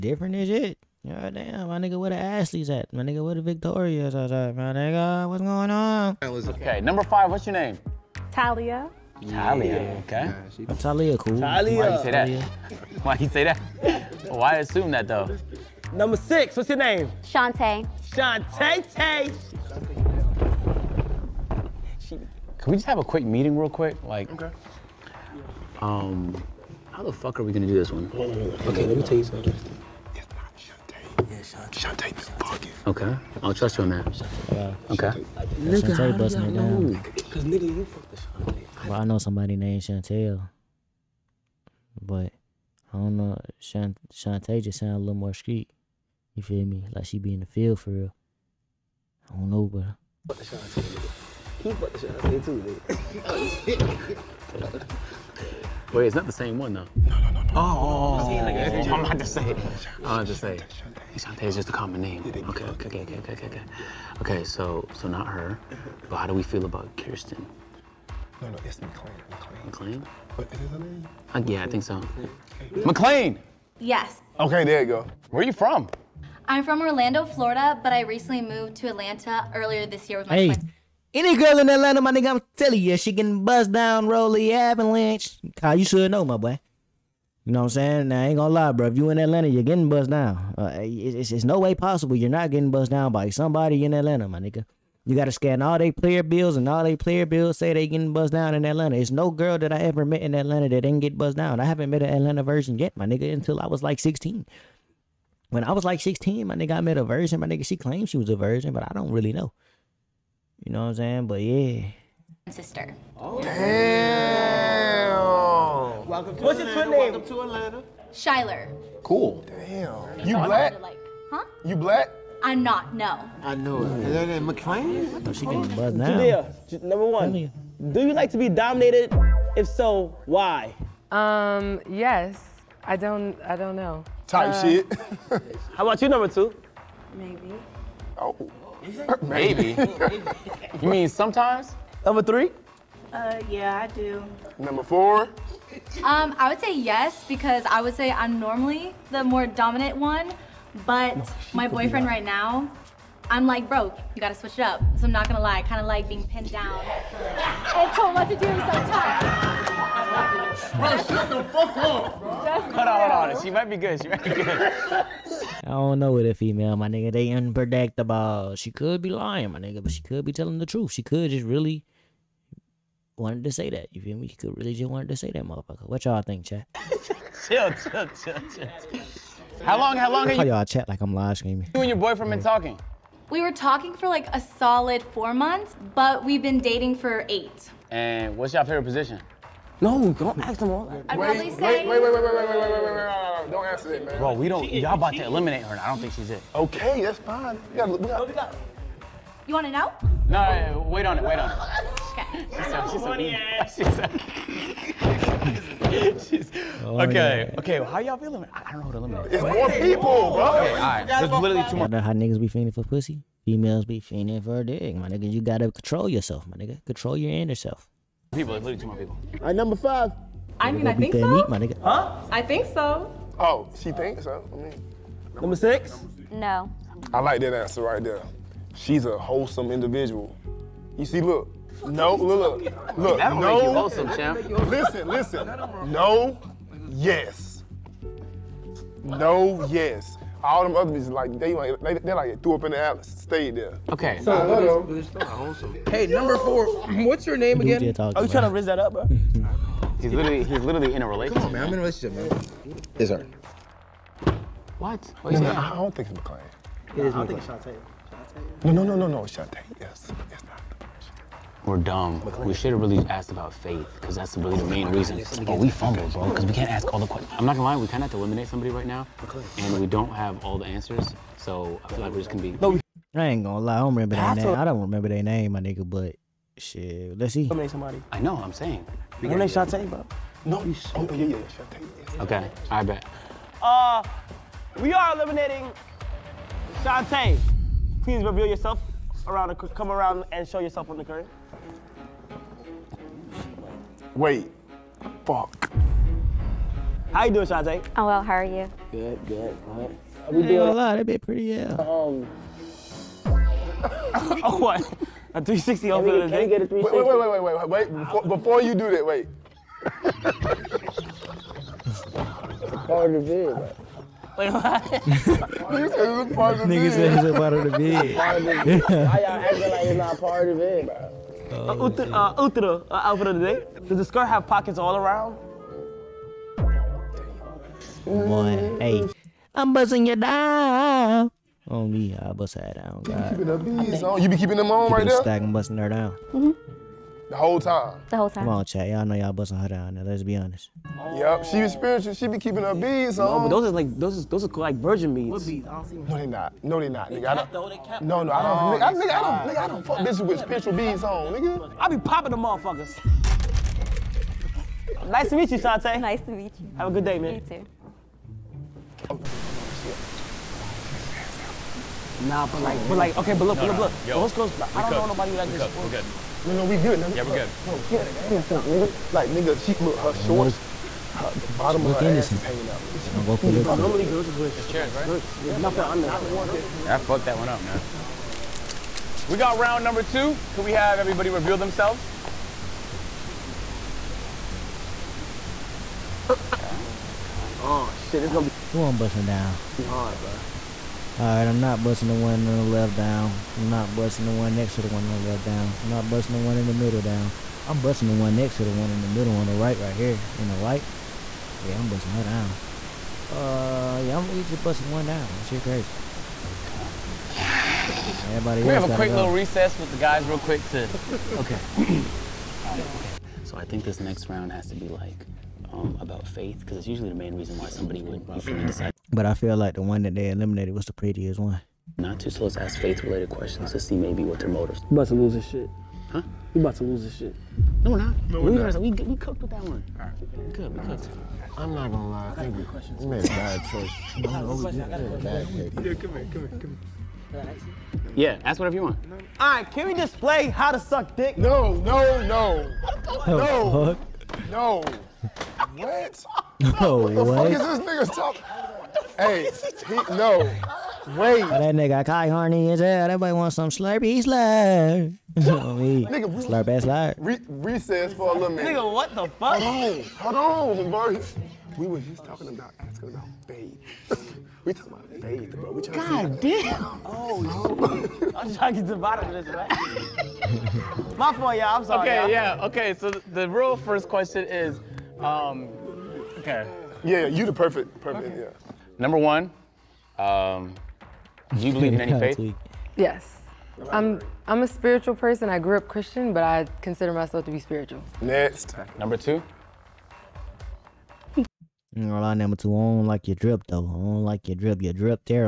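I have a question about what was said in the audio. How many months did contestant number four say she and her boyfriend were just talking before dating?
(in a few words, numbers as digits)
4.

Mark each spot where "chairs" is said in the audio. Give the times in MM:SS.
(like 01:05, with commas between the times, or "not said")
06:14.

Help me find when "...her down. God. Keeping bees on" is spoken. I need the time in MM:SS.
05:32.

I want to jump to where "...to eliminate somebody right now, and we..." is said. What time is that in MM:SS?
04:28.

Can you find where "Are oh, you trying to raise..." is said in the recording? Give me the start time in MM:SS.
04:07.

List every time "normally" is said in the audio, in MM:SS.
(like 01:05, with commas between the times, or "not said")
02:28, 06:13.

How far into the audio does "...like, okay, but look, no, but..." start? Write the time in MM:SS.
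06:02.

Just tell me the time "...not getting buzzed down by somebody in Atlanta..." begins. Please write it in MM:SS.
01:32.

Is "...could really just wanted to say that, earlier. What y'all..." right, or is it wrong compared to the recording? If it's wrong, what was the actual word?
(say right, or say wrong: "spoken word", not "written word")
wrong: "motherfucker", not "earlier".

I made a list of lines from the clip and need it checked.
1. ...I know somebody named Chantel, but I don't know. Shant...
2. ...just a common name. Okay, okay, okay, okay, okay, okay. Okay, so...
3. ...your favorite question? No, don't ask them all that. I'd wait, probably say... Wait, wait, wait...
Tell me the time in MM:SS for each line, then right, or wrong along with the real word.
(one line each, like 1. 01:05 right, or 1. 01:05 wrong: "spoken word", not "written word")
1. 00:39 right
2. 01:01 right
3. 03:08 wrong: "position", not "question".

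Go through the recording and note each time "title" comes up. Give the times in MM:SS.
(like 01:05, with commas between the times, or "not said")
not said.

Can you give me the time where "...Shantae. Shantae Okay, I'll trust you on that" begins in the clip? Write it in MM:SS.
00:31.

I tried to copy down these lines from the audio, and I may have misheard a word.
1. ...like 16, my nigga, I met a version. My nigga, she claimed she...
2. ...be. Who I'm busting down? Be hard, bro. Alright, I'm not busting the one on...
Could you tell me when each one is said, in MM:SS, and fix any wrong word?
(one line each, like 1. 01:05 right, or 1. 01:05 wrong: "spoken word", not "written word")
1. 01:45 right
2. 06:28 right.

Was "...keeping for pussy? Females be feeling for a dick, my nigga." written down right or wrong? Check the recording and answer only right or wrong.
wrong.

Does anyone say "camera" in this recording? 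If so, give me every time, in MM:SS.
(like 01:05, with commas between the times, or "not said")
not said.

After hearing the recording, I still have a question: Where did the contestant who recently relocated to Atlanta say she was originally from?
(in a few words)
Orlando, Florida.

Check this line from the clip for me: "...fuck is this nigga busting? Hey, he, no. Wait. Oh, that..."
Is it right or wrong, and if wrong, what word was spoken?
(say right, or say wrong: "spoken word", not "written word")
wrong: "talking", not "busting".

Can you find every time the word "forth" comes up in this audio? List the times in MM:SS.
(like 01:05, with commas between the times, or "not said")
not said.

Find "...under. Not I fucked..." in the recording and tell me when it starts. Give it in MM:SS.
06:15.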